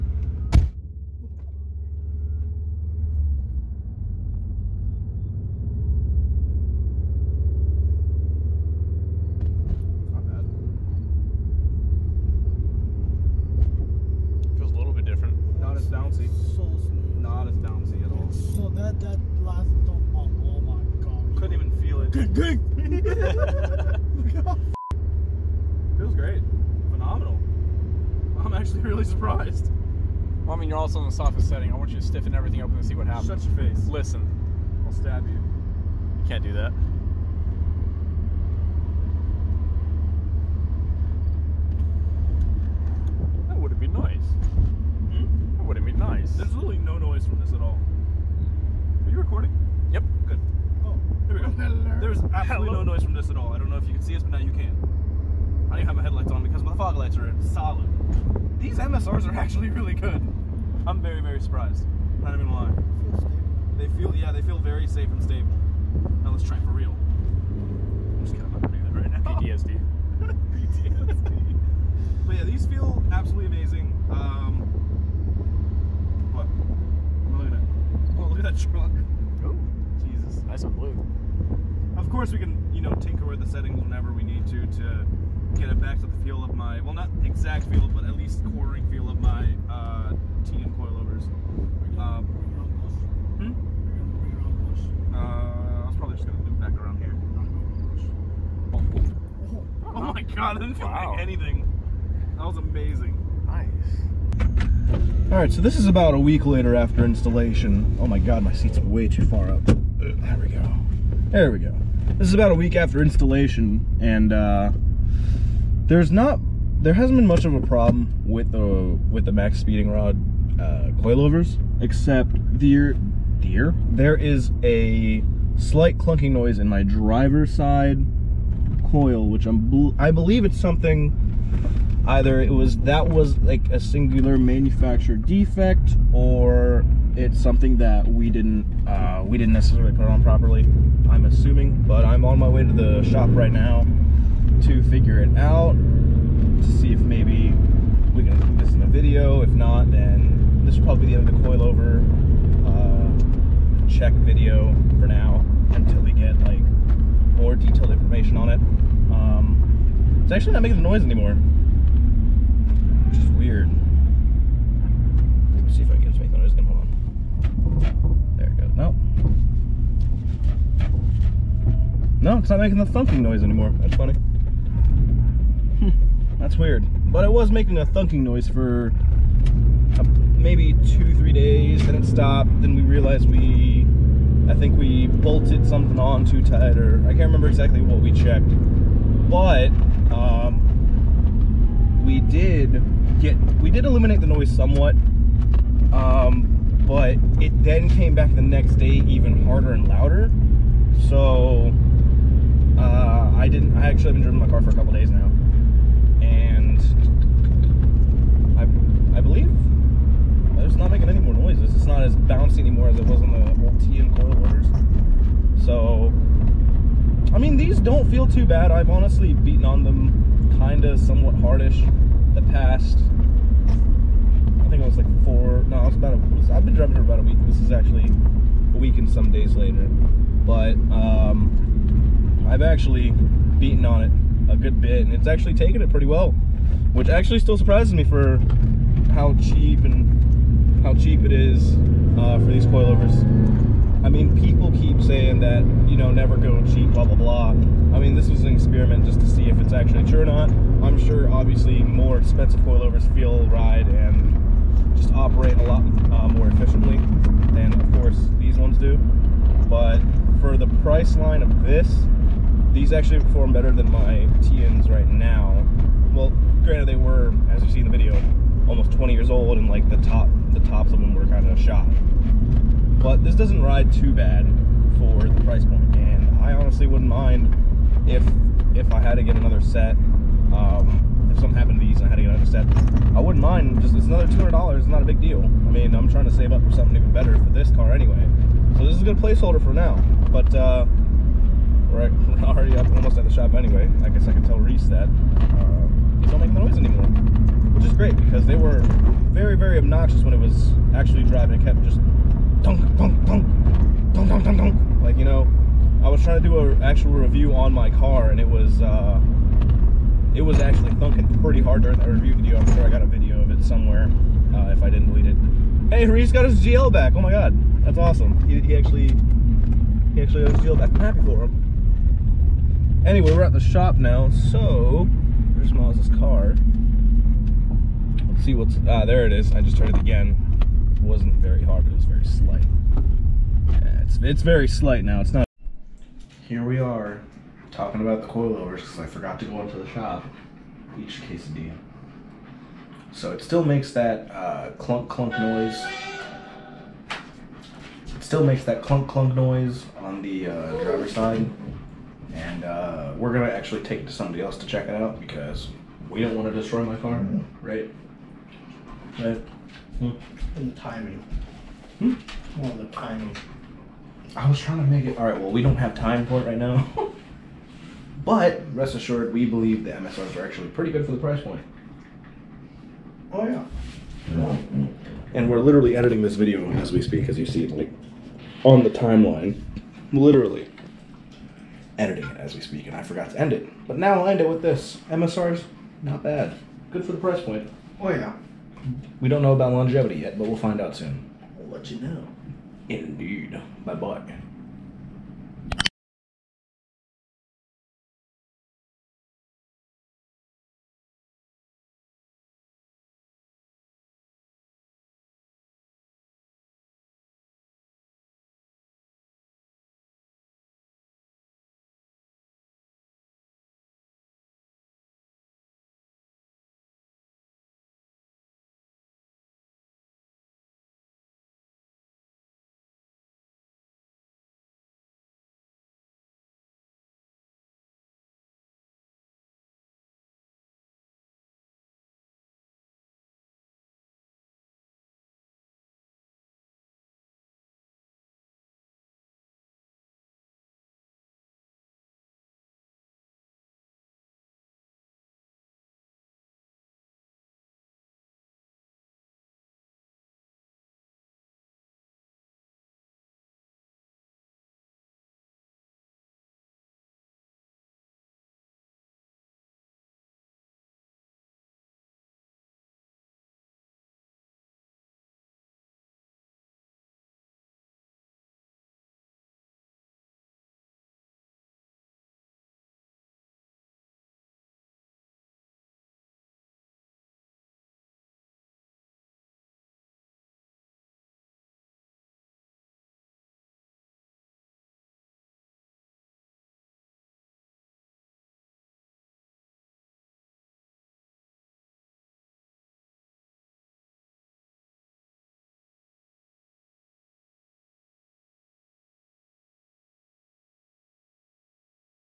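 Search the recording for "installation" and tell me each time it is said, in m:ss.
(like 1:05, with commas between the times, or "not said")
1:47, 1:53.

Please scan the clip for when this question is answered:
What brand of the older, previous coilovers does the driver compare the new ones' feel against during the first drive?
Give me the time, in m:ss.
1:30.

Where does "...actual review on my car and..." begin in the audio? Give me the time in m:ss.
5:06.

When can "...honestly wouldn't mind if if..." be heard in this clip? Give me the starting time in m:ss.
4:36.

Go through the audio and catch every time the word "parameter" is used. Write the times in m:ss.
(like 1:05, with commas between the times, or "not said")
not said.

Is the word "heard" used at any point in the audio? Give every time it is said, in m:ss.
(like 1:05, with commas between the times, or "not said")
5:29.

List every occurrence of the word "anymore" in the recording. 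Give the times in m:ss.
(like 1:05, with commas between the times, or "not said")
2:41, 2:53, 3:32, 4:56.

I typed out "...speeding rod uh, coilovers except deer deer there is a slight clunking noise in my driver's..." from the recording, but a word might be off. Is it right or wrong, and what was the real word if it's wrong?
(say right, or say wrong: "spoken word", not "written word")
right.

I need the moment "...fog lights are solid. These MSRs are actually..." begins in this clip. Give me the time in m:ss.
0:56.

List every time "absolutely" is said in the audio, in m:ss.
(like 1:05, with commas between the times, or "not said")
0:52, 1:13.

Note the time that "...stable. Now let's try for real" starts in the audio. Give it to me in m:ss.
1:05.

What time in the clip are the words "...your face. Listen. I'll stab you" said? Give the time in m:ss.
0:33.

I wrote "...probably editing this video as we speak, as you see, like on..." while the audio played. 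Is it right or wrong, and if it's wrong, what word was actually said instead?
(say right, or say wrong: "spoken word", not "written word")
wrong: "literally", not "probably".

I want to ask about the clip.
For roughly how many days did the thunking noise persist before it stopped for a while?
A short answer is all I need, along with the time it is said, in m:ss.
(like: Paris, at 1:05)
two, three days, at 3:00.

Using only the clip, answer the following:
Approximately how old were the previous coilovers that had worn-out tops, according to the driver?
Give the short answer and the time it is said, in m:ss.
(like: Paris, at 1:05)
almost 20 years, at 4:28.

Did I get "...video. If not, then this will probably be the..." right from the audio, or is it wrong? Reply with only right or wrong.
right.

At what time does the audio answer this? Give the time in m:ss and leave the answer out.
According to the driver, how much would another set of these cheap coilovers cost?
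4:44.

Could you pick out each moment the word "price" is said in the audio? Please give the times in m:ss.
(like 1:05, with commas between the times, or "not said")
4:20, 4:35, 6:11, 6:27.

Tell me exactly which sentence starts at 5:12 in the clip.
I'm sure I got a video of it somewhere uh, if I didn't delete it.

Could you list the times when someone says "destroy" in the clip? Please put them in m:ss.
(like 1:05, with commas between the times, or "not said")
5:56.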